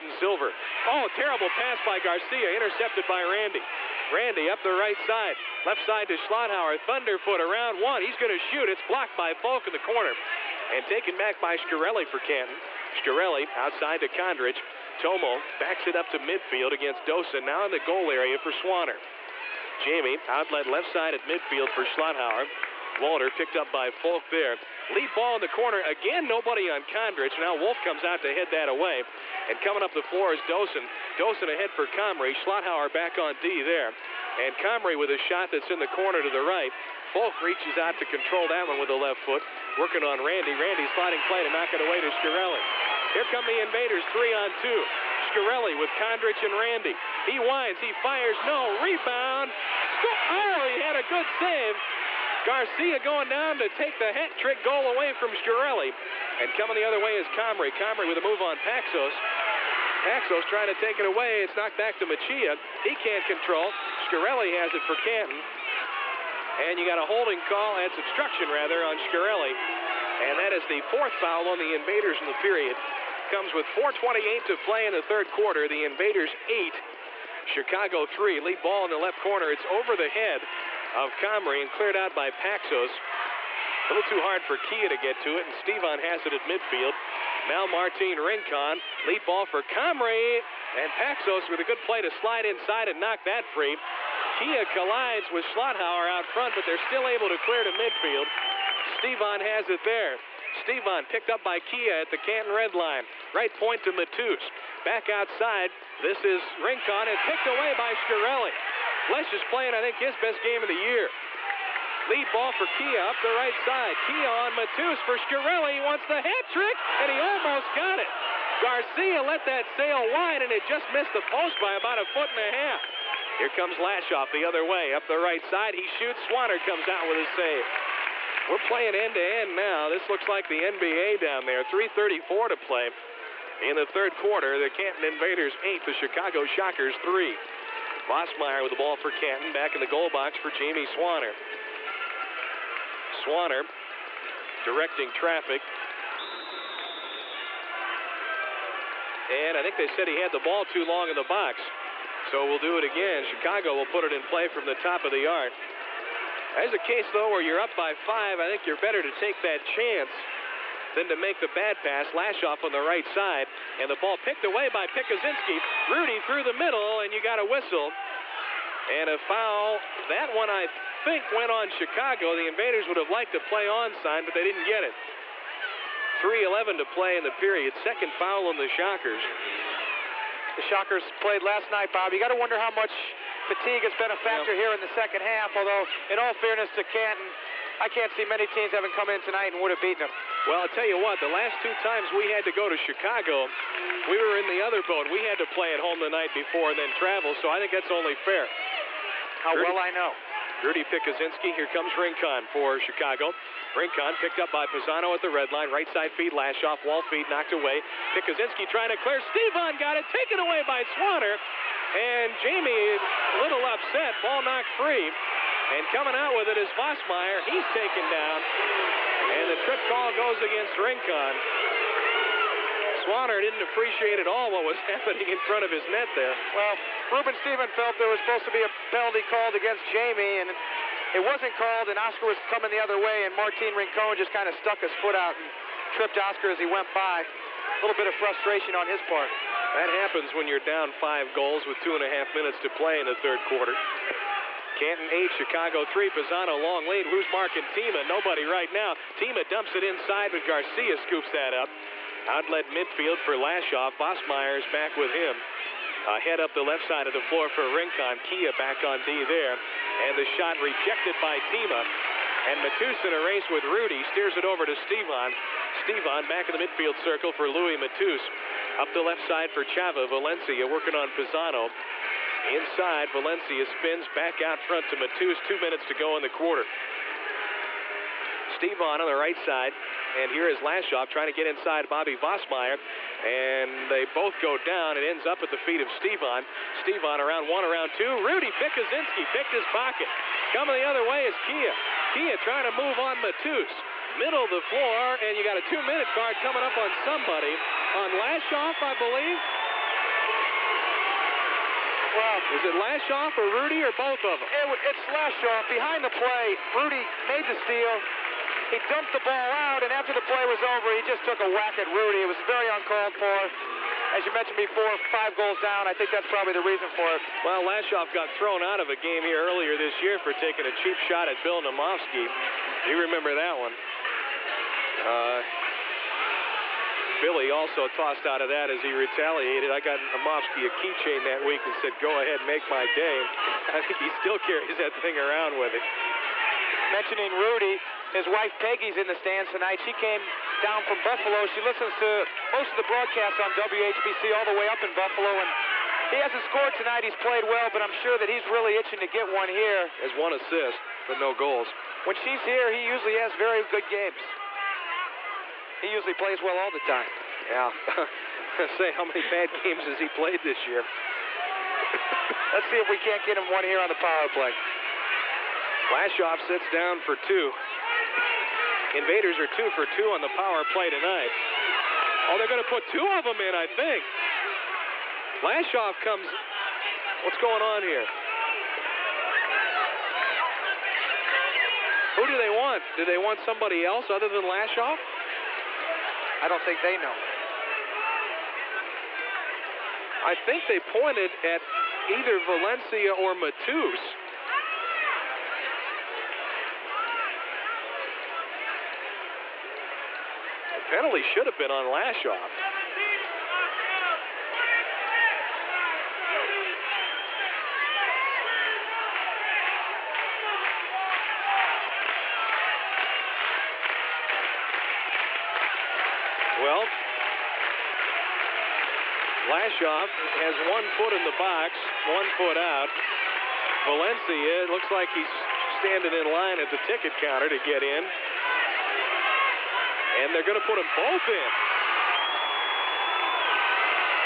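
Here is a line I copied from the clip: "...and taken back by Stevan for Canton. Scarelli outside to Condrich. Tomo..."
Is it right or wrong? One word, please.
wrong.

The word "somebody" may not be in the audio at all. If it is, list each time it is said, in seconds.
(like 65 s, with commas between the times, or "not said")
296 s, 383 s.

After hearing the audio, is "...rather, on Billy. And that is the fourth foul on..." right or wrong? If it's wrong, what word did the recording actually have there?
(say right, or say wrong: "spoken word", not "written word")
wrong: "Scarelli", not "Billy".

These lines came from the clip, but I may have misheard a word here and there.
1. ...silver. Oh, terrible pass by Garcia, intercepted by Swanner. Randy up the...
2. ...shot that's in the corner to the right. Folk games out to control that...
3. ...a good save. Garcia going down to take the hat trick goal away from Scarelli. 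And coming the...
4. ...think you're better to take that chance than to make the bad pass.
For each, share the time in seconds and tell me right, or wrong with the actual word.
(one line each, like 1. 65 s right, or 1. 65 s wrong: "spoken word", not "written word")
1. 0 s wrong: "Randy", not "Swanner"
2. 35 s wrong: "reaches", not "games"
3. 50 s right
4. 158 s right.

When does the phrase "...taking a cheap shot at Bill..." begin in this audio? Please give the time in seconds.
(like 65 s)
320 s.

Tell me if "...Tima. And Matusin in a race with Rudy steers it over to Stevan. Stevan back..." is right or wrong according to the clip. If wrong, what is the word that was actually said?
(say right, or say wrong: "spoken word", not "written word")
right.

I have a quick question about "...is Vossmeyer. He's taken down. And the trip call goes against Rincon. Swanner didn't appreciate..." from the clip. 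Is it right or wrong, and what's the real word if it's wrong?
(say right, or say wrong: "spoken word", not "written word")
right.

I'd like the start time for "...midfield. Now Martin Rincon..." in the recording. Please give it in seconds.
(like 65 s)
86 s.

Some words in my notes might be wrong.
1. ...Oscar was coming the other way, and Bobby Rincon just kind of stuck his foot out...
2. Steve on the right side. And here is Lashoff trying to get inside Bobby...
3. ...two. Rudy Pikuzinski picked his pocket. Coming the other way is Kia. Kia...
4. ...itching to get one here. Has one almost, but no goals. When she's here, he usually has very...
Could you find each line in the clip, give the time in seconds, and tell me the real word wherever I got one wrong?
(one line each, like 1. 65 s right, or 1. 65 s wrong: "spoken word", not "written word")
1. 232 s wrong: "Martin", not "Bobby"
2. 278 s right
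3. 287 s right
4. 348 s wrong: "assist", not "almost".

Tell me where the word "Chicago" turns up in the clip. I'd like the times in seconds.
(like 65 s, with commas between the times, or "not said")
77 s, 135 s, 153 s, 171 s, 192 s, 202 s, 245 s.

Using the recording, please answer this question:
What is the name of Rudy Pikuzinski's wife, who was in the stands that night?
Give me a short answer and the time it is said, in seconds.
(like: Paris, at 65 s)
Peggy, at 338 s.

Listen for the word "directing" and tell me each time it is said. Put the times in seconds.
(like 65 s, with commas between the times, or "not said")
144 s.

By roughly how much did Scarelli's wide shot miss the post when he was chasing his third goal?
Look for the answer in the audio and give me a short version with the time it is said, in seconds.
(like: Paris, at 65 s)
a foot and a half, at 121 s.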